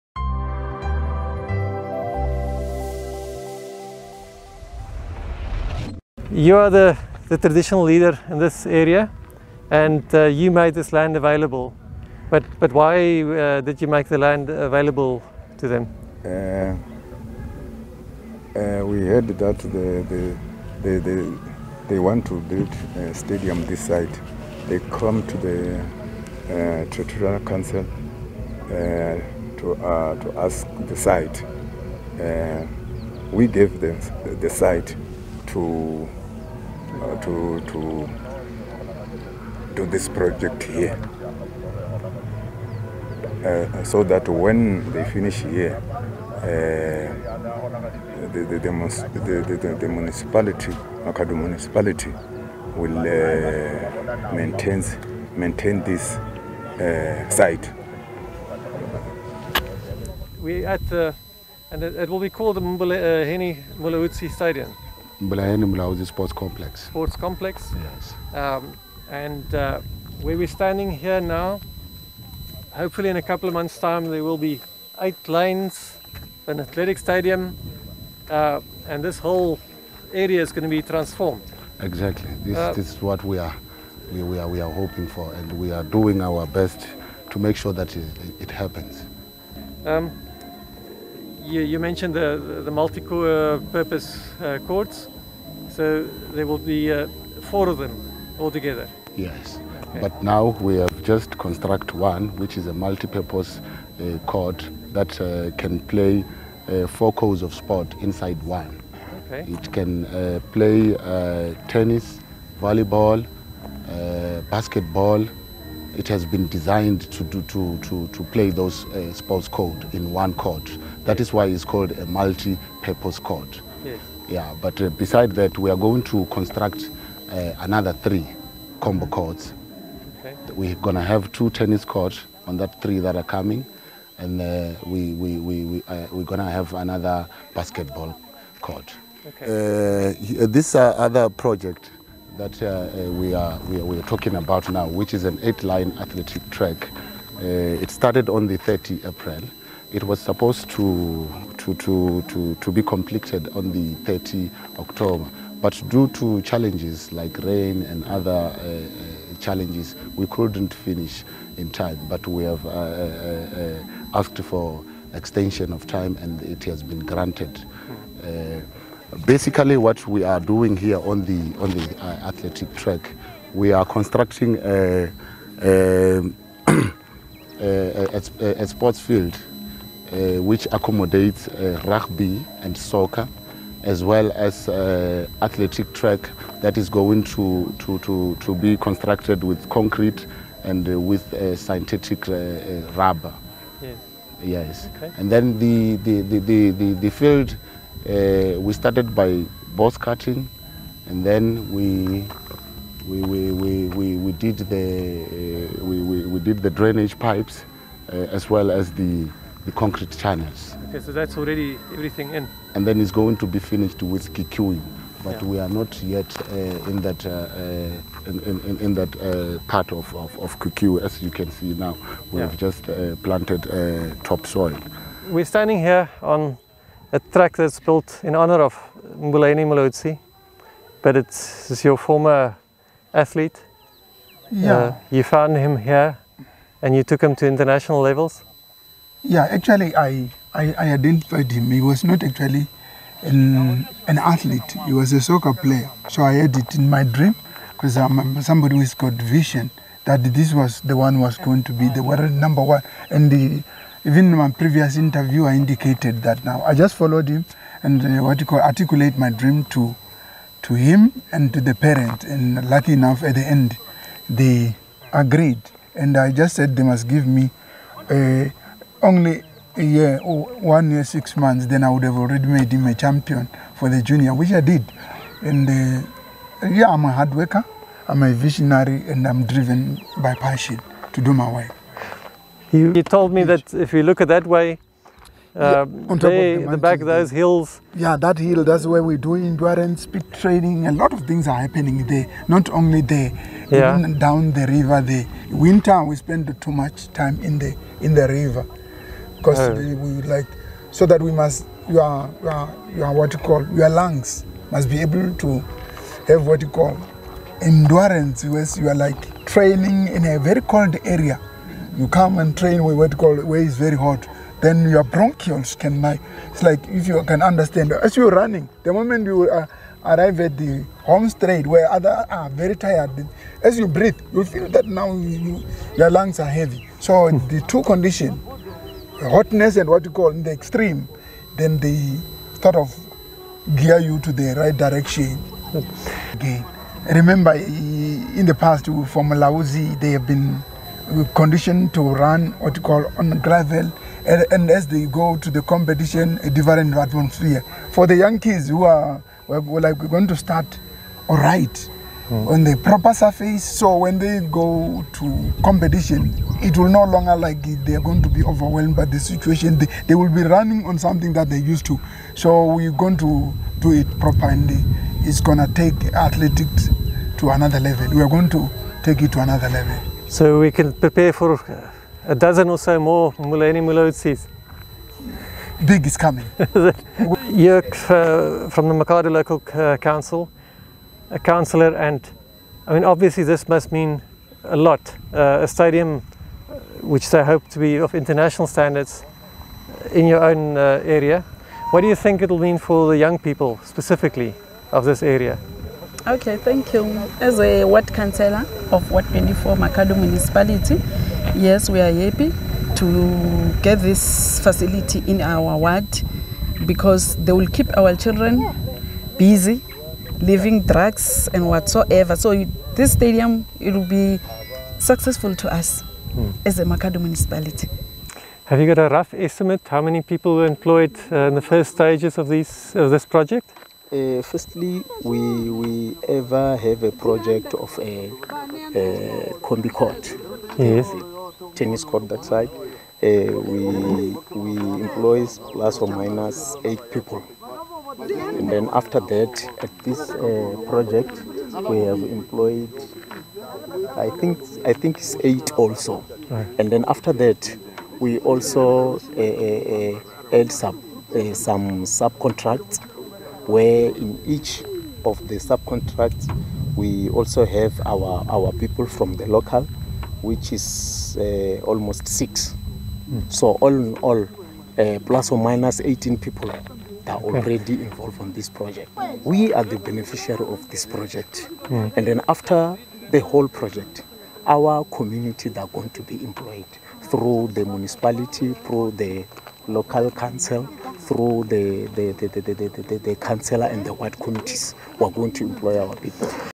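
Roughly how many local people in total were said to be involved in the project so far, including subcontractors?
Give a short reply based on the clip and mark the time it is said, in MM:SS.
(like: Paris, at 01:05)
18, at 07:46.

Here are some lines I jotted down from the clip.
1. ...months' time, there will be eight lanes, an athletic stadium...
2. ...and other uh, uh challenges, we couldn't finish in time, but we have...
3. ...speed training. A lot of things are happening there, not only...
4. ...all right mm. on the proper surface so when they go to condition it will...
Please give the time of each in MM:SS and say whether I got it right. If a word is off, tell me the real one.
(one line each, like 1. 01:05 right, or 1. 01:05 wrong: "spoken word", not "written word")
1. 01:13 right
2. 02:37 right
3. 04:50 right
4. 05:51 wrong: "competition", not "condition".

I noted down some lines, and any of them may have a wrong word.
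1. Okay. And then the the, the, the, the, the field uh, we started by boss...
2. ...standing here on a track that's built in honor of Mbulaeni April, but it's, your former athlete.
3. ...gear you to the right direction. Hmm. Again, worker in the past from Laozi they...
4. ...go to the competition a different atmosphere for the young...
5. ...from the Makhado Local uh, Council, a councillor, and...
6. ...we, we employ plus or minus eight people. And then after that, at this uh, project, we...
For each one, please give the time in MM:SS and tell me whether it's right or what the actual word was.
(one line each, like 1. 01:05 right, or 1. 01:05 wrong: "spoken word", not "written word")
1. 03:14 right
2. 03:45 wrong: "Mulaudzi", not "April"
3. 05:33 wrong: "remember", not "worker"
4. 05:45 right
5. 06:18 right
6. 07:13 right.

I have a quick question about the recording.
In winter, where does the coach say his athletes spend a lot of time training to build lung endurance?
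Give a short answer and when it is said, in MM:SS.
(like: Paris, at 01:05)
In the river, at 04:57.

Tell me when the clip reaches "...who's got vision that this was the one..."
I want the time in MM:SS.
04:08.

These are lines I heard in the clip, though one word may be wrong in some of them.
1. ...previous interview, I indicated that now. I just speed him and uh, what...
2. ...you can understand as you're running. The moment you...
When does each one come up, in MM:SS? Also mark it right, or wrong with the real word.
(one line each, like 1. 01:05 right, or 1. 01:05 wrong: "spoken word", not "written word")
1. 04:14 wrong: "followed", not "speed"
2. 05:17 right.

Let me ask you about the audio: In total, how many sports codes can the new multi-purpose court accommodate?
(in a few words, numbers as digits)
4.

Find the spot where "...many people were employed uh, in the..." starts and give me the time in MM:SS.
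07:00.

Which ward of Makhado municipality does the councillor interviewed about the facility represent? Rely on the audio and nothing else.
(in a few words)
Ward 24.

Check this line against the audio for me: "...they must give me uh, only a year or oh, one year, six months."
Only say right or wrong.
right.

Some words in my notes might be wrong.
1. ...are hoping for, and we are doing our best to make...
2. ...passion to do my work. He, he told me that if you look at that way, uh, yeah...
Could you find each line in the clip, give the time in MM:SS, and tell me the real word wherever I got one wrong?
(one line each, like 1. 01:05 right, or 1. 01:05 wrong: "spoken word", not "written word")
1. 01:24 right
2. 04:40 right.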